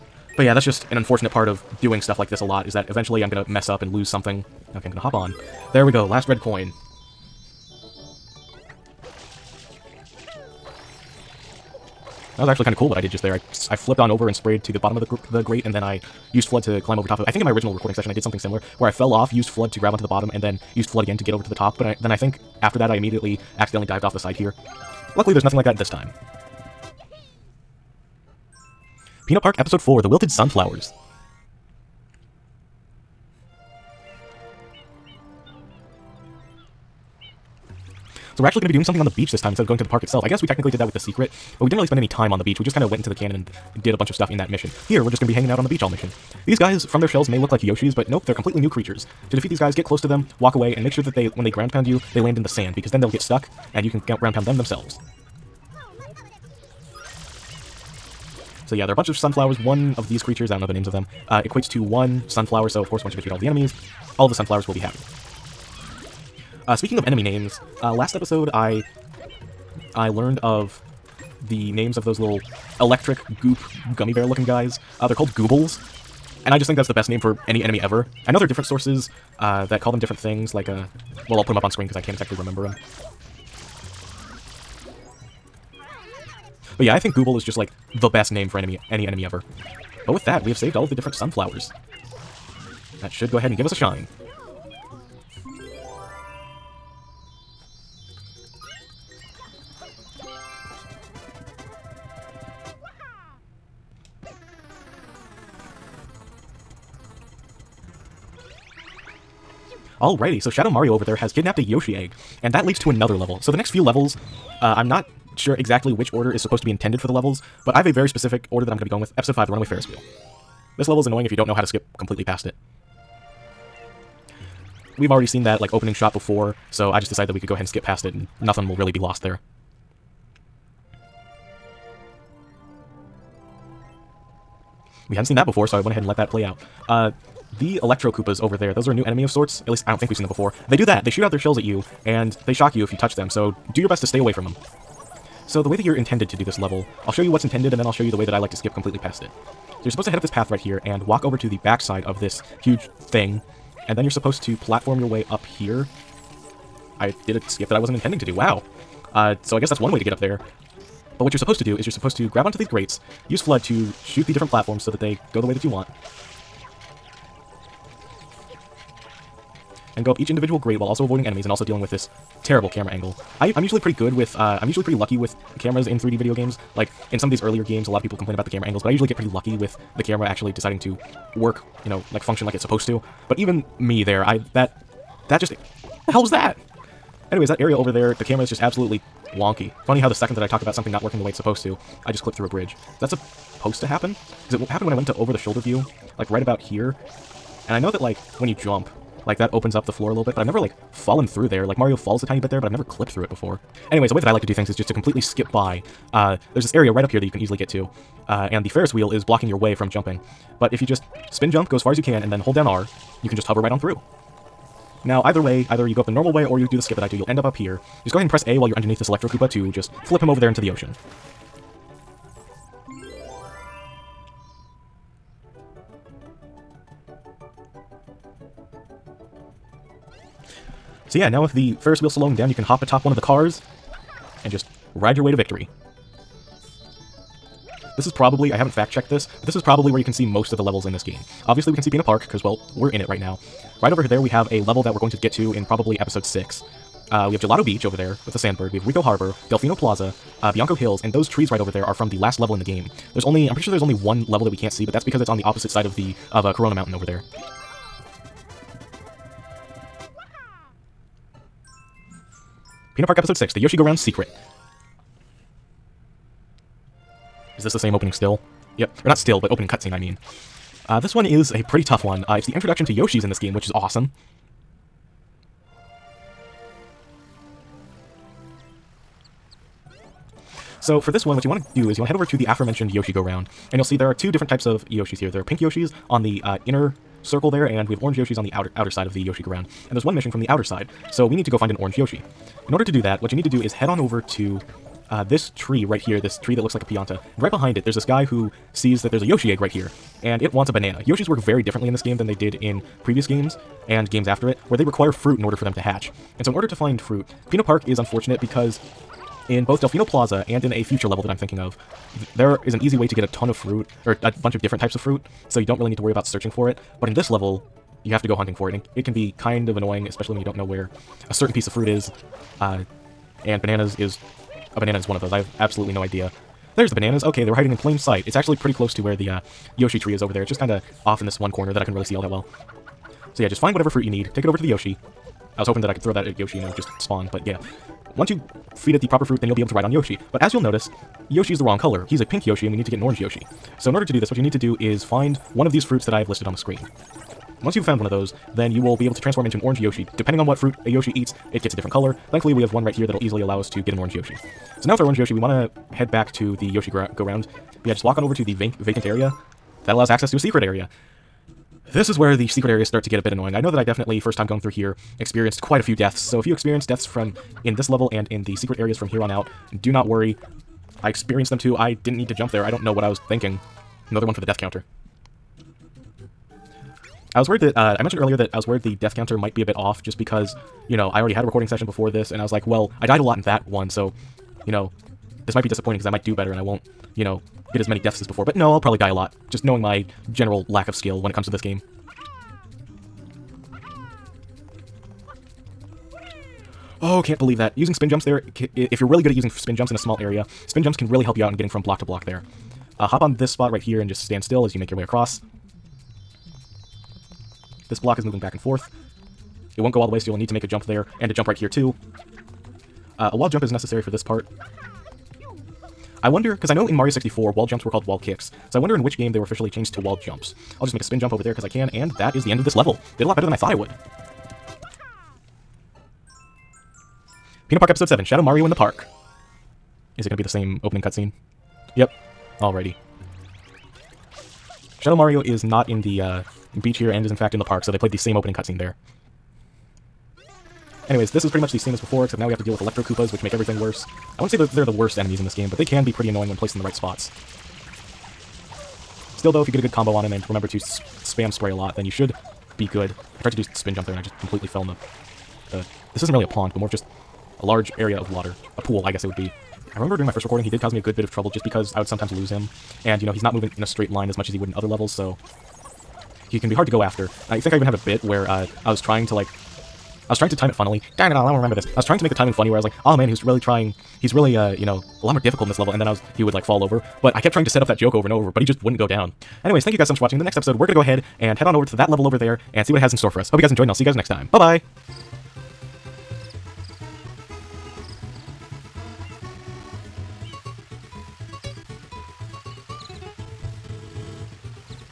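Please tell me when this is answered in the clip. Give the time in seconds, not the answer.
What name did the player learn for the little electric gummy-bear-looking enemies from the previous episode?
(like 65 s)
75 s.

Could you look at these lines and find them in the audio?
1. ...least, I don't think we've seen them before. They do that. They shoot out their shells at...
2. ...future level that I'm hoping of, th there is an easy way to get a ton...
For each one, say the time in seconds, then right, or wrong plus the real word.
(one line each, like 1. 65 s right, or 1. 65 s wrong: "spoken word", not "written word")
1. 139 s right
2. 310 s wrong: "thinking", not "hoping".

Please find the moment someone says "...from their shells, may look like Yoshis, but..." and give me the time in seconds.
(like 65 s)
46 s.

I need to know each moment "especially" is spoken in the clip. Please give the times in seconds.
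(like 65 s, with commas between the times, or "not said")
320 s.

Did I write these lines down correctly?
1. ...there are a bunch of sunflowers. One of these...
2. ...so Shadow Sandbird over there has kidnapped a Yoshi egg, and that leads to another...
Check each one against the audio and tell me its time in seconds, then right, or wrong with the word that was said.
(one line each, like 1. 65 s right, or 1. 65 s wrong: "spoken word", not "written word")
1. 58 s right
2. 110 s wrong: "Mario", not "Sandbird".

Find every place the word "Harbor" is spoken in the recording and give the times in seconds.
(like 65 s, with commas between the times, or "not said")
249 s.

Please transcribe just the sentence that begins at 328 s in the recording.
It's actually pretty close to where the uh, Yoshi tree is over there.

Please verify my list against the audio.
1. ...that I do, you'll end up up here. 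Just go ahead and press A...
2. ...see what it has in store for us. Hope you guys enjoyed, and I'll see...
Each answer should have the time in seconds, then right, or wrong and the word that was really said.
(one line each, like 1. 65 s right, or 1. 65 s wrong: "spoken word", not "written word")
1. 216 s right
2. 482 s right.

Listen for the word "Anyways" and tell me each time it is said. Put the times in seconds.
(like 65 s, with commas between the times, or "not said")
187 s, 203 s, 441 s, 479 s.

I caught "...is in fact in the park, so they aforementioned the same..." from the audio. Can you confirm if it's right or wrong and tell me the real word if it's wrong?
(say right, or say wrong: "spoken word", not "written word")
wrong: "played", not "aforementioned".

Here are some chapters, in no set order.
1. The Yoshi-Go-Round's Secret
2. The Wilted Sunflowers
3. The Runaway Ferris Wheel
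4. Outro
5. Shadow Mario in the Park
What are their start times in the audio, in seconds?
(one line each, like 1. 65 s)
1. 228 s
2. 28 s
3. 117 s
4. 479 s
5. 426 s.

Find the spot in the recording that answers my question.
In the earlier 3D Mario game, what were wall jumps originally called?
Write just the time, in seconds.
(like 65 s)
418 s.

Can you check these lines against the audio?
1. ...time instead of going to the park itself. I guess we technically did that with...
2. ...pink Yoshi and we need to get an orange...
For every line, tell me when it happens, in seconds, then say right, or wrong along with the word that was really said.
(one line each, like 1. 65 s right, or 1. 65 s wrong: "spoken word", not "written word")
1. 39 s right
2. 342 s right.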